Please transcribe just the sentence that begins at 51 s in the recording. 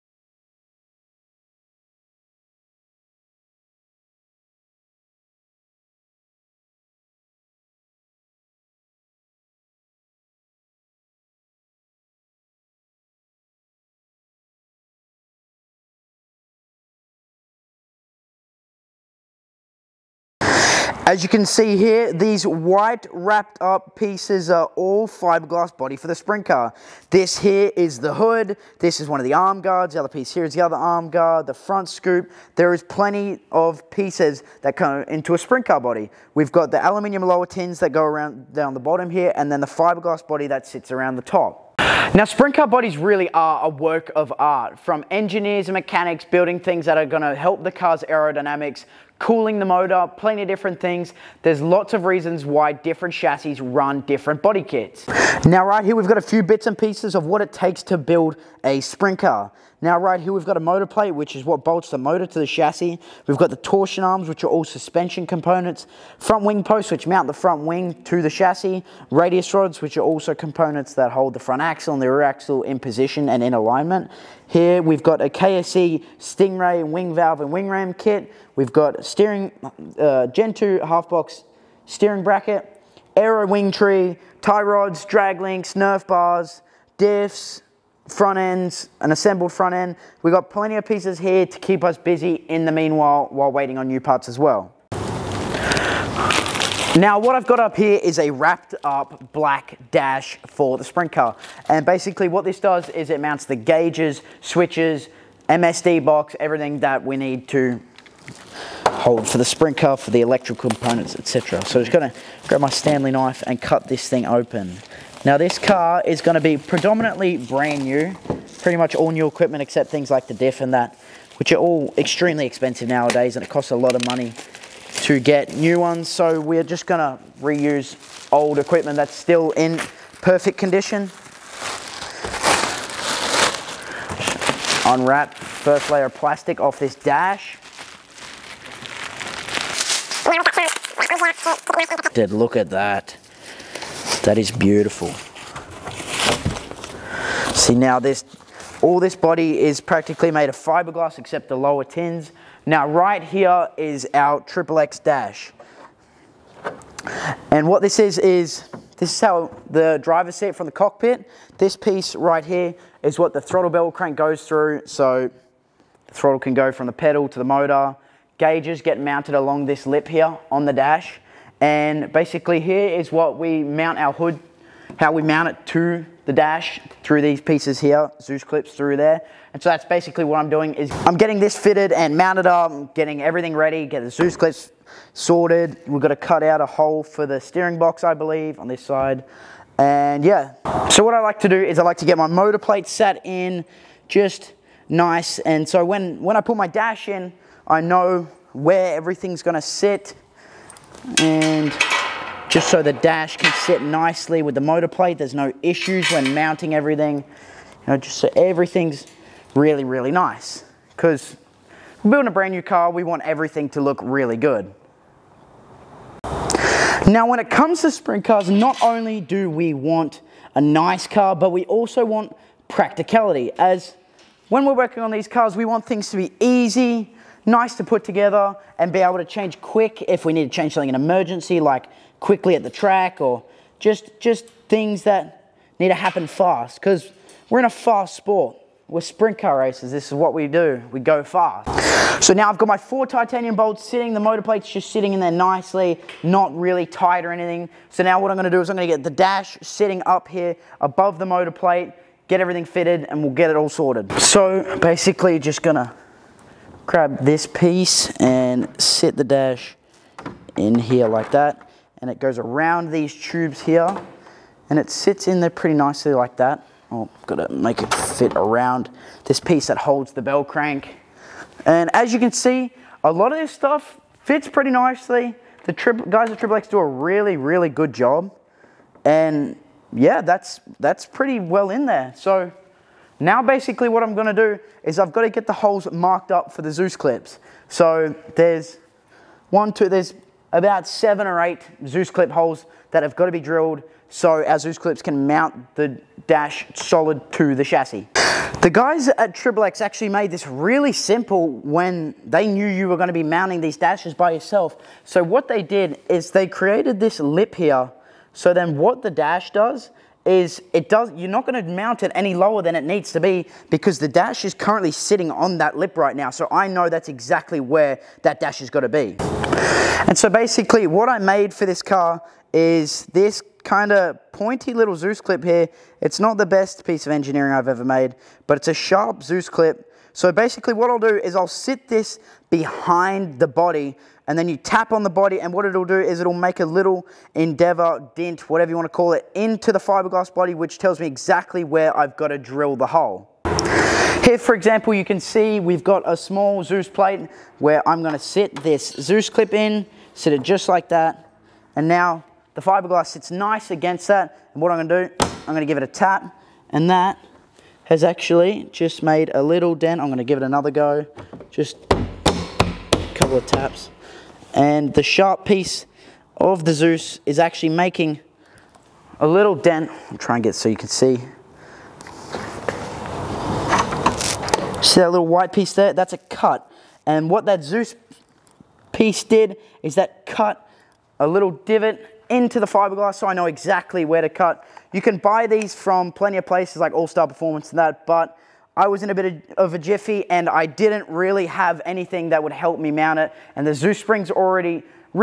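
There's lots of reasons why different chassis run different body kits.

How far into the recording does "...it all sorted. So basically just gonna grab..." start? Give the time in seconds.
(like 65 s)
253 s.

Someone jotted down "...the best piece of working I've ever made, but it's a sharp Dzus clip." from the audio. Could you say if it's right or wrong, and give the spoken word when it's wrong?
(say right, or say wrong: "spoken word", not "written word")
wrong: "engineering", not "working".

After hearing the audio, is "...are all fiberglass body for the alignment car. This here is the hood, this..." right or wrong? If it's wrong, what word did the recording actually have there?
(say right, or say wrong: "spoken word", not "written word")
wrong: "sprint", not "alignment".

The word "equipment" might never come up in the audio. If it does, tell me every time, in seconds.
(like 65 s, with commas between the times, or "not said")
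119 s, 128 s.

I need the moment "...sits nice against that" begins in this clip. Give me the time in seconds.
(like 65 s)
353 s.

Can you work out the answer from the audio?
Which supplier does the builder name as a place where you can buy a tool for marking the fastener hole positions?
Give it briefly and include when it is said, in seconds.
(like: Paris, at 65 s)
All Star Performance, at 386 s.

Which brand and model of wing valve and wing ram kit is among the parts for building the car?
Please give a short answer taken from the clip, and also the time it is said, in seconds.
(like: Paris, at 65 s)
KSE Stingray, at 75 s.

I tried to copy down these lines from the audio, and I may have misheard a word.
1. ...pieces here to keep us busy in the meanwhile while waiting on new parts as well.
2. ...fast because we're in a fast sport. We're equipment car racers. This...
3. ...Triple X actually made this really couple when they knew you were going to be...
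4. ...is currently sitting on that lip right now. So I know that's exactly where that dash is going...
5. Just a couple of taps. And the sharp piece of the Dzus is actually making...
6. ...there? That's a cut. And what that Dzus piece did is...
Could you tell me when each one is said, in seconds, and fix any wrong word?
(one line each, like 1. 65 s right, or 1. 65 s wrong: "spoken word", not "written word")
1. 90 s right
2. 236 s wrong: "sprint", not "equipment"
3. 299 s wrong: "simple", not "couple"
4. 314 s right
5. 361 s right
6. 375 s right.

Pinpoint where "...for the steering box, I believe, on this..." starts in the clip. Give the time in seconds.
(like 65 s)
187 s.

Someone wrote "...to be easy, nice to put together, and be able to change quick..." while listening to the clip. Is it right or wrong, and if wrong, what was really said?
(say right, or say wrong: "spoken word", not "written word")
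right.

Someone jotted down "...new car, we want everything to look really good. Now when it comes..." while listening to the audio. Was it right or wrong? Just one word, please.
right.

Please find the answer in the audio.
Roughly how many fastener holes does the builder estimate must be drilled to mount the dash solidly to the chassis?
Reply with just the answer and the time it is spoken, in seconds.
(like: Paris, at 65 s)
7 or 8, at 290 s.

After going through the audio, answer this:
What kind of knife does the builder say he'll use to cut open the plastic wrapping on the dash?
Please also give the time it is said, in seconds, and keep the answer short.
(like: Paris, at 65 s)
Stanley knife, at 112 s.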